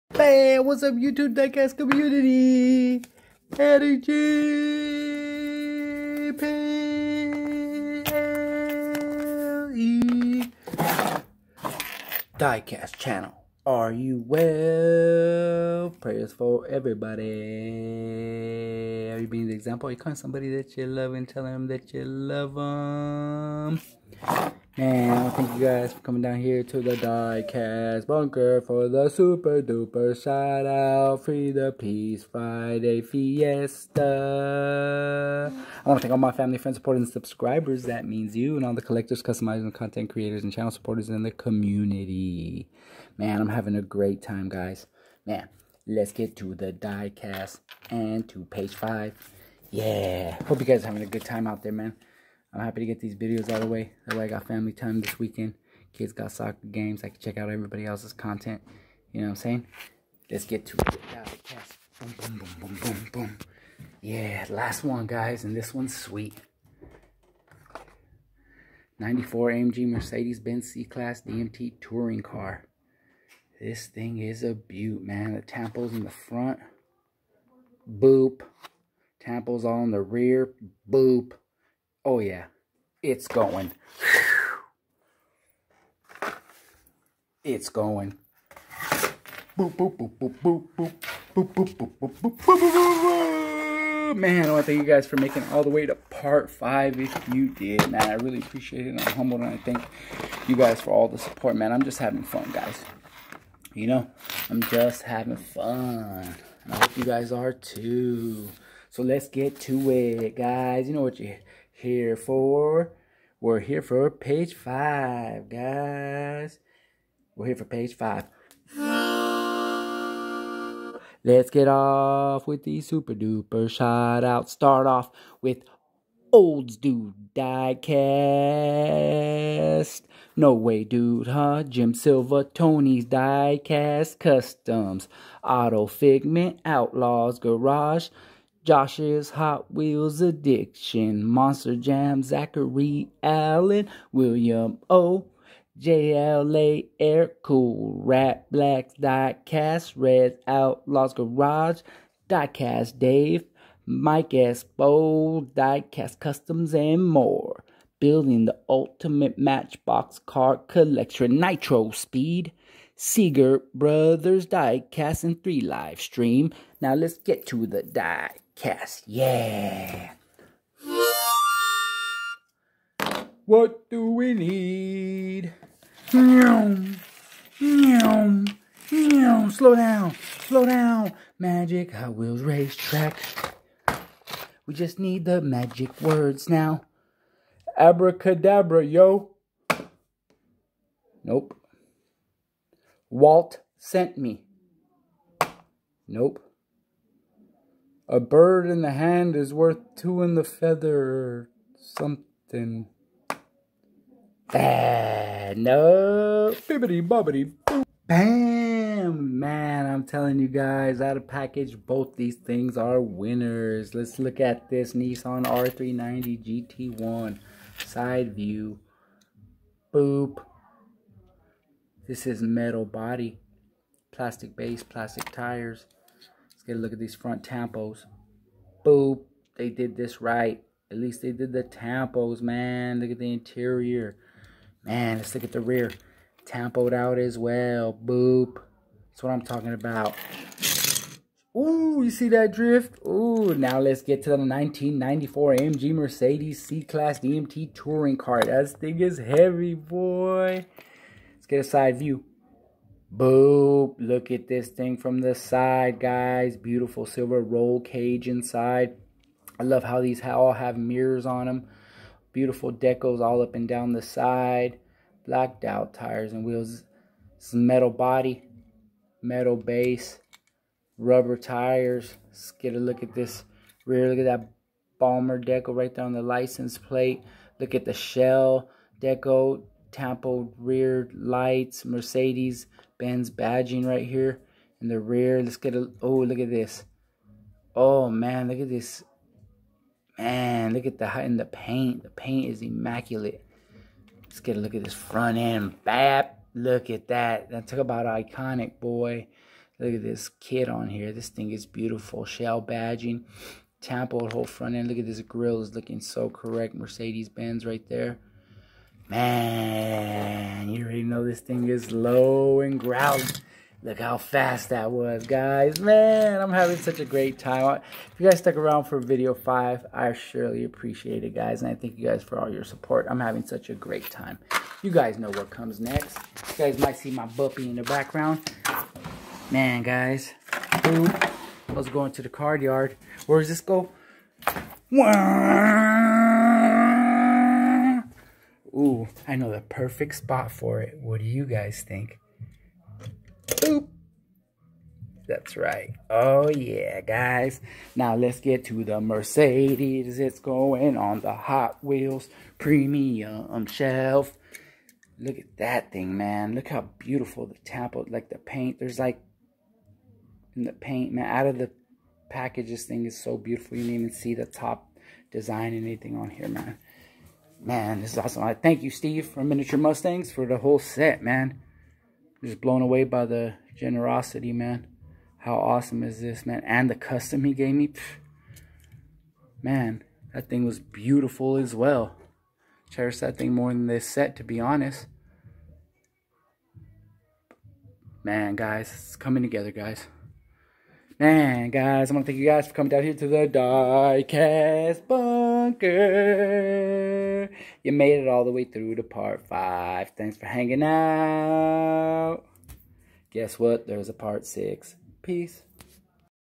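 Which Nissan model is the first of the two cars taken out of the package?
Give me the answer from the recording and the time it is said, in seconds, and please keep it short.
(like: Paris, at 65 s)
R390 GT1, at 215 s.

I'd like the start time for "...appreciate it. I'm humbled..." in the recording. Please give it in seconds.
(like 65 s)
98 s.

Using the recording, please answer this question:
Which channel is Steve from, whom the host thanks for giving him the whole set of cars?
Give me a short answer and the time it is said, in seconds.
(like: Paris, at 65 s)
Miniature Mustangs, at 369 s.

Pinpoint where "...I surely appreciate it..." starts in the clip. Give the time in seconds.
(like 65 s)
319 s.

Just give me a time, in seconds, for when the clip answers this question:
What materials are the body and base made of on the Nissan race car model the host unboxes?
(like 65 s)
222 s.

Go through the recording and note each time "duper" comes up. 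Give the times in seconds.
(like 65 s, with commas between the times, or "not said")
29 s, 123 s.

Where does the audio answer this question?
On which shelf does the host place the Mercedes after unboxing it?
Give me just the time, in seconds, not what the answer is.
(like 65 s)
351 s.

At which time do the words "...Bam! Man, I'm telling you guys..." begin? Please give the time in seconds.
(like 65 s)
208 s.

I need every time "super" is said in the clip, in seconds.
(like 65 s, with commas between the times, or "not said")
29 s, 122 s.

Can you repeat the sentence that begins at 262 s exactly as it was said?
Beautiful deco's all up and down the side.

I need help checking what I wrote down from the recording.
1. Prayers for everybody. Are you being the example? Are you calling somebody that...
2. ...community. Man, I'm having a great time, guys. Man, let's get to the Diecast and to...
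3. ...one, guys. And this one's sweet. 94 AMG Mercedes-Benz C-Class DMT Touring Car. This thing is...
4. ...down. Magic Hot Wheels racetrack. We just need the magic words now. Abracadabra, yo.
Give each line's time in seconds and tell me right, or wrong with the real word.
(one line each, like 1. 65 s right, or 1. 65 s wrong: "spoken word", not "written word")
1. 15 s right
2. 41 s right
3. 64 s right
4. 180 s right.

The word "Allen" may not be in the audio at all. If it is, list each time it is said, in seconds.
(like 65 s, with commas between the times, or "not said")
143 s.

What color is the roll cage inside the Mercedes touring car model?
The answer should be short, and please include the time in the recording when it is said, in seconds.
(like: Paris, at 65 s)
Silver, at 257 s.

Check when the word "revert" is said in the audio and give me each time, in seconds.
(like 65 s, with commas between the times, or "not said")
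not said.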